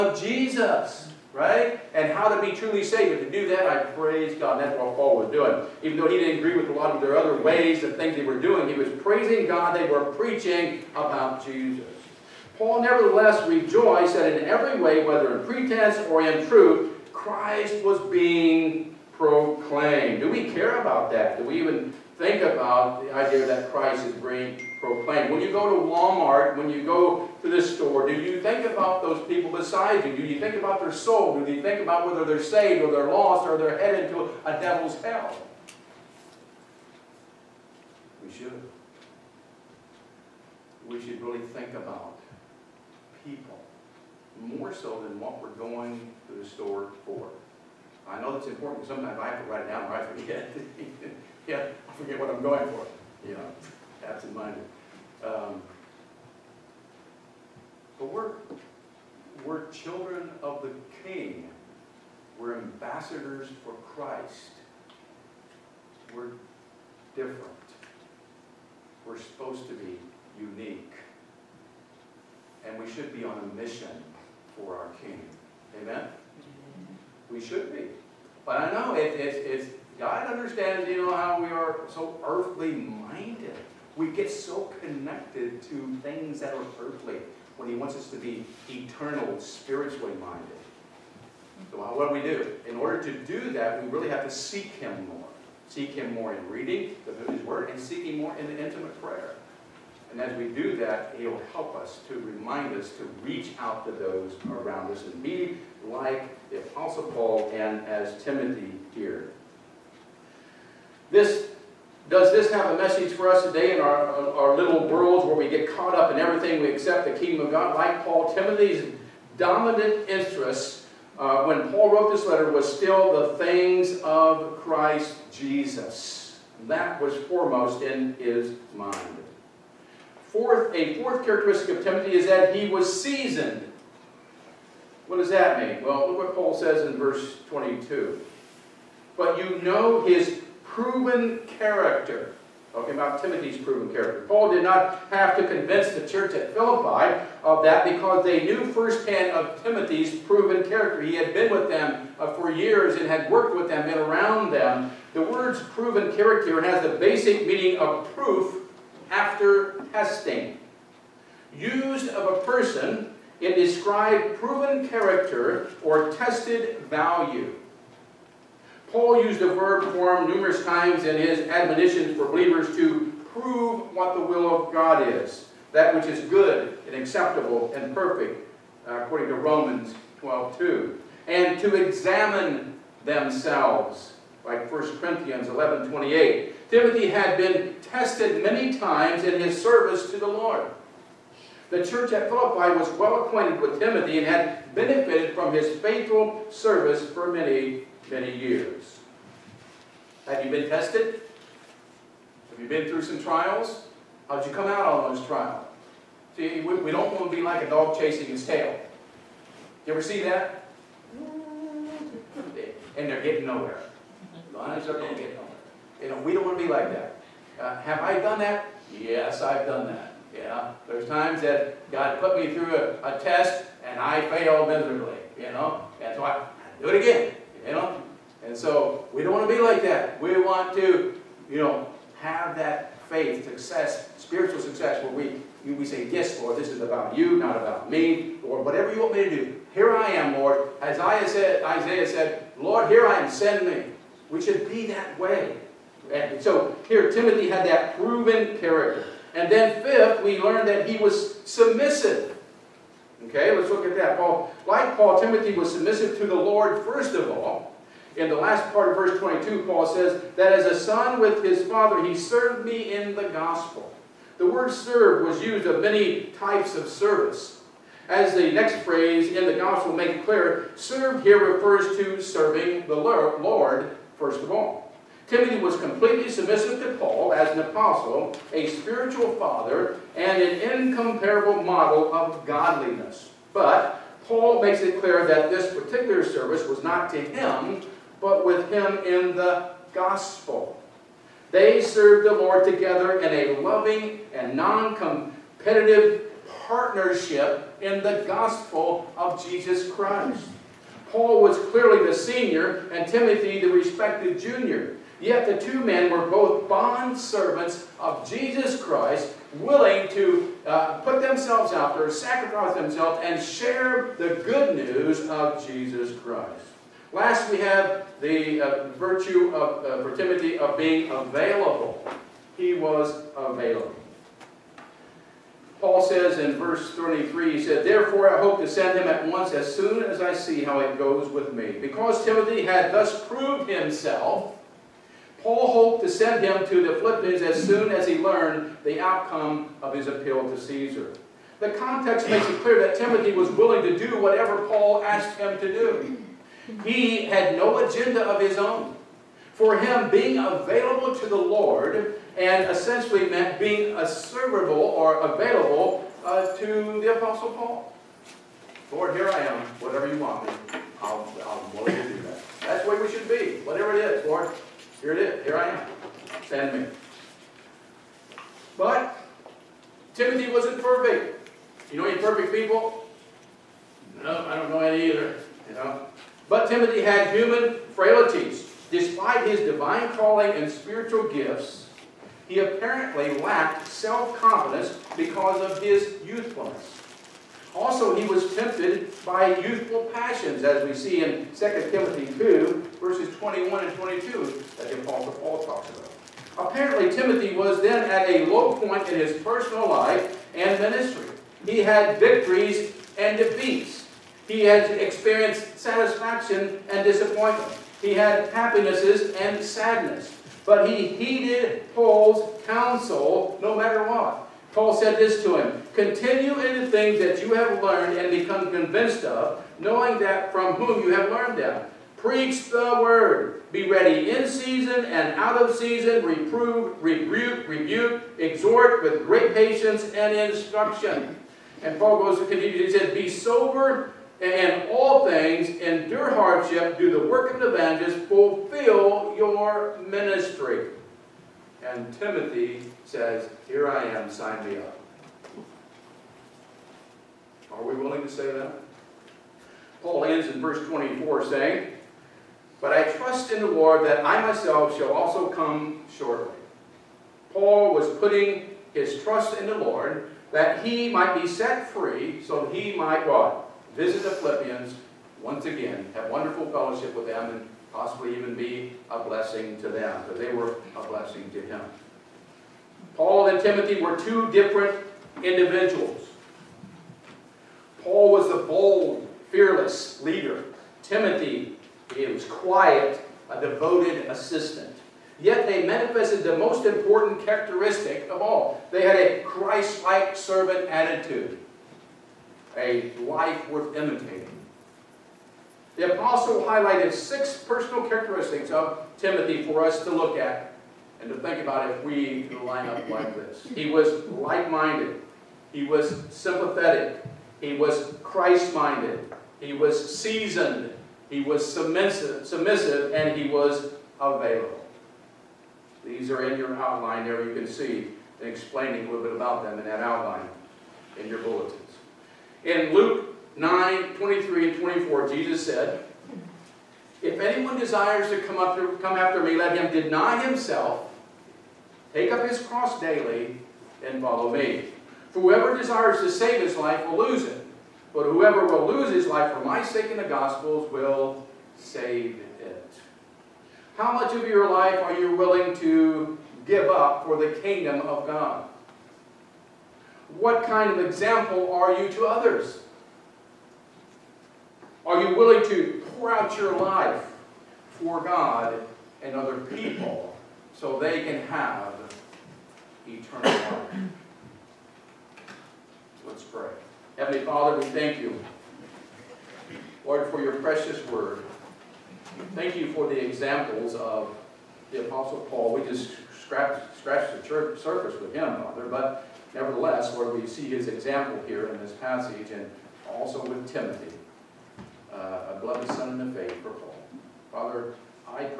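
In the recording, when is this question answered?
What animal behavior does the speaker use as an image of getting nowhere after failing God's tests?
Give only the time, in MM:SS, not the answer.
03:27.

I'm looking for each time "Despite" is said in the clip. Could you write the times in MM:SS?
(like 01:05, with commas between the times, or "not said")
06:18.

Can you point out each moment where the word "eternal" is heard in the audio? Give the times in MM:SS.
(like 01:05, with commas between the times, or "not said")
01:28, 09:23.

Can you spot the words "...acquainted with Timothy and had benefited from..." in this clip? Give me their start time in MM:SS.
03:13.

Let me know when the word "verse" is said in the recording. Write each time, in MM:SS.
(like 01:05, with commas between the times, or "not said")
02:16, 04:18, 05:26, 06:32, 07:30.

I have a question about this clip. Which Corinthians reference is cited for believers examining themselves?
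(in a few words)
1 Corinthians 11:28.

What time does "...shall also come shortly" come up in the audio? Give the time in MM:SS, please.
07:34.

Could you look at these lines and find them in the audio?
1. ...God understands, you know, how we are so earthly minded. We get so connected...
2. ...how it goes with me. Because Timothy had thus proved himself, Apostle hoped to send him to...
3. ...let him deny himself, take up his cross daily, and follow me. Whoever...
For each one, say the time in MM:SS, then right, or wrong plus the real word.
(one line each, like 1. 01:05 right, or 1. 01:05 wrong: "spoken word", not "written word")
1. 01:19 right
2. 05:30 wrong: "Paul", not "Apostle"
3. 08:49 right.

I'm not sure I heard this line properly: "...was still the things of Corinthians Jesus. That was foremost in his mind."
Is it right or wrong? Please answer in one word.
wrong.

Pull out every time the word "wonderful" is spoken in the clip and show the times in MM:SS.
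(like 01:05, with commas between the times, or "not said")
07:46.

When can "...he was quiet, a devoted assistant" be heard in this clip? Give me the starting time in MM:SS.
08:02.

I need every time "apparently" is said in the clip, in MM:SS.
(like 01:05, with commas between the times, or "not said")
06:22, 06:36.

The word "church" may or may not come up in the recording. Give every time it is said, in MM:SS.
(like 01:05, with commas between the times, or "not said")
02:26, 03:11, 09:37.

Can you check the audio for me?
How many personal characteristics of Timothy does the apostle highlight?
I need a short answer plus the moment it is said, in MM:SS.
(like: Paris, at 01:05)
6, at 08:17.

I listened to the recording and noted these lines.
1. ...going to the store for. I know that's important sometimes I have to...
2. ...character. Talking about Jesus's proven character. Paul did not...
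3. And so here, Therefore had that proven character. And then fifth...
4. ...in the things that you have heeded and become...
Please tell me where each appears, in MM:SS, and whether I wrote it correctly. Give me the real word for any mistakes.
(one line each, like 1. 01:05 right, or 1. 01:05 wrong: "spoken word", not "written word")
1. 00:45 right
2. 02:21 wrong: "Timothy", not "Jesus"
3. 04:06 wrong: "Timothy", not "Therefore"
4. 06:56 wrong: "learned", not "heeded".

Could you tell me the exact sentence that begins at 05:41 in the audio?
The context makes it clear that Timothy was willing to do whatever Paul asked him to do.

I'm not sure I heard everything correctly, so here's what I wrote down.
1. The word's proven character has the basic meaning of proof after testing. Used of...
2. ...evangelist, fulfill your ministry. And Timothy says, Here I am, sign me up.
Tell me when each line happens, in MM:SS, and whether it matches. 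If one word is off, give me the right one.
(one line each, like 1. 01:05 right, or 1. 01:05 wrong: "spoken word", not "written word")
1. 02:35 right
2. 07:17 right.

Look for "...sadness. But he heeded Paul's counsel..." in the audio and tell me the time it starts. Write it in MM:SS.
06:49.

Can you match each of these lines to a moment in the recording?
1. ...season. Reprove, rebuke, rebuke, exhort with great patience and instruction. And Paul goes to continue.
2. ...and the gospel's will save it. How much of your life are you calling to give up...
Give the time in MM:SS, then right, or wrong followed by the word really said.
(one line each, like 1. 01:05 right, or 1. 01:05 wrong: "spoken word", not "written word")
1. 07:05 right
2. 09:00 wrong: "willing", not "calling".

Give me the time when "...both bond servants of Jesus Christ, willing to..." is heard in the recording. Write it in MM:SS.
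05:06.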